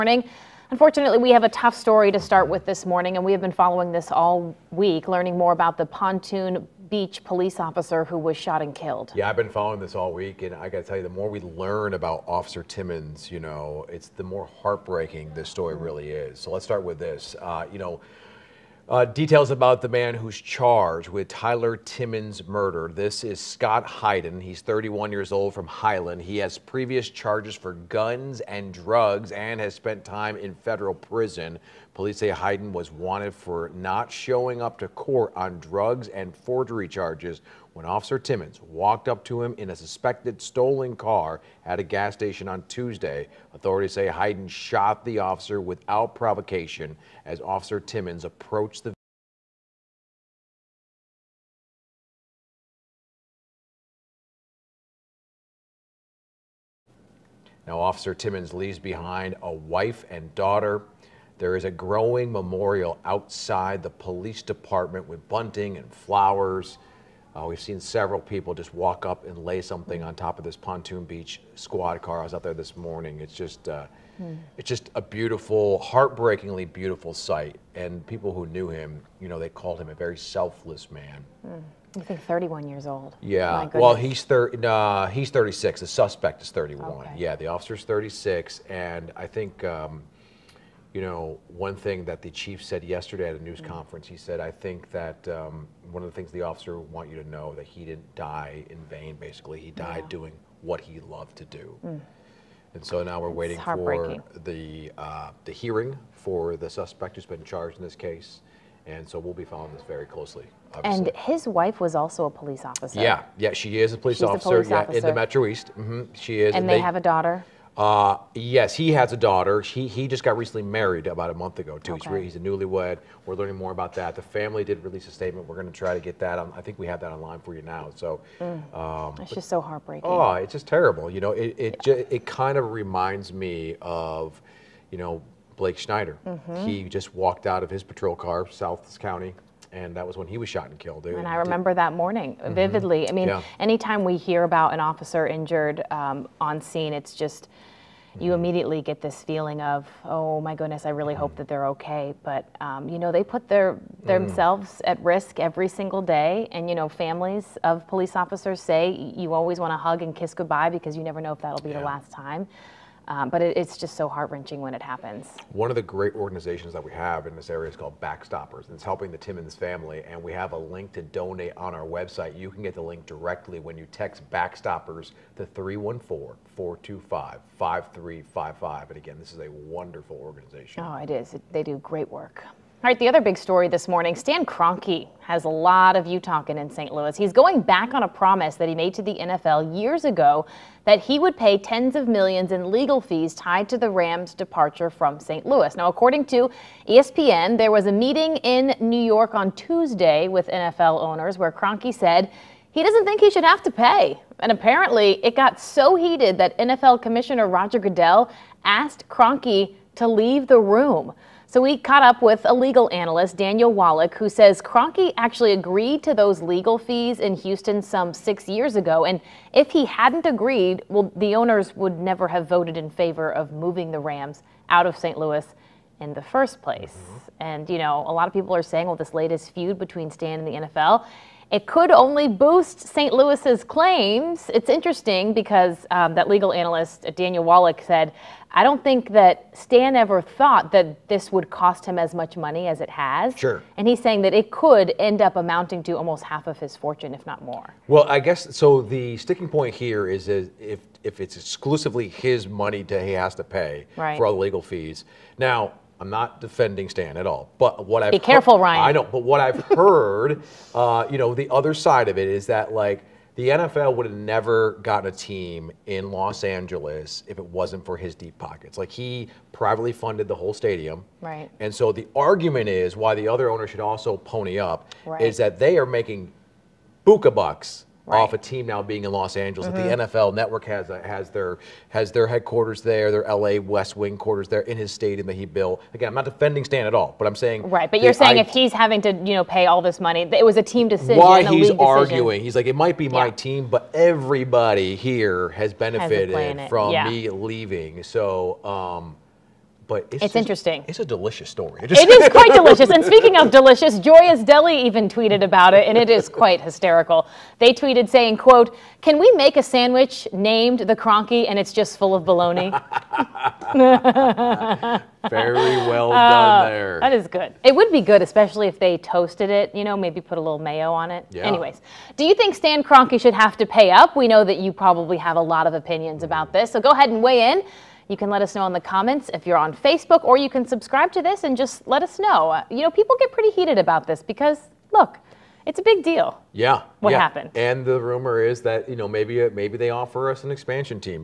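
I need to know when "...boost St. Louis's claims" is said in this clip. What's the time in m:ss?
3:52.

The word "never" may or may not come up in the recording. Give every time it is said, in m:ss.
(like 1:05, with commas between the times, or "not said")
2:41, 3:41, 4:24.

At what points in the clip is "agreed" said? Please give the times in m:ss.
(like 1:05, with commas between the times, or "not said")
3:35, 3:40.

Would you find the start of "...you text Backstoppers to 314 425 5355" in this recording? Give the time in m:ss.
2:53.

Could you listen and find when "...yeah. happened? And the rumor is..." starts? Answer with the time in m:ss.
5:37.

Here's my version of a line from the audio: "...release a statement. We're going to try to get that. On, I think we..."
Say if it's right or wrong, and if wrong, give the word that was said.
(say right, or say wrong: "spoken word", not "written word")
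right.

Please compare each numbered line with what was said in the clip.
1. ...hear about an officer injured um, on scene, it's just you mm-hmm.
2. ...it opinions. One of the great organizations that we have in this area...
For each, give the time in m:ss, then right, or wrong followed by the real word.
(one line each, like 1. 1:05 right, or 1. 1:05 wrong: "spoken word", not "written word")
1. 2:24 right
2. 2:44 wrong: "happens", not "opinions".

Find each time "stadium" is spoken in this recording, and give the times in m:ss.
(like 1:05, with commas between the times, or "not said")
4:30, 4:44.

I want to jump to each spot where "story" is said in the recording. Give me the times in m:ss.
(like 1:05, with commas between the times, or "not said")
0:01, 0:15, 3:03, 5:01.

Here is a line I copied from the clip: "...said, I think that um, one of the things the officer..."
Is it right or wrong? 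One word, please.
right.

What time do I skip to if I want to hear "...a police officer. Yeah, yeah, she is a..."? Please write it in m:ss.
1:52.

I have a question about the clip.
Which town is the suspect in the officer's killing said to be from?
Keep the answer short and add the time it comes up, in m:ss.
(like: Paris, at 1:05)
Highland, at 0:25.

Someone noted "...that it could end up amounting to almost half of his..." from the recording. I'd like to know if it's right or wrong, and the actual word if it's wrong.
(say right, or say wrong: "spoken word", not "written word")
right.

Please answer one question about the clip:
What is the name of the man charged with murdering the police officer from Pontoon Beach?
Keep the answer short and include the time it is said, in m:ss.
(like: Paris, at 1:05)
Scott Hayden, at 0:23.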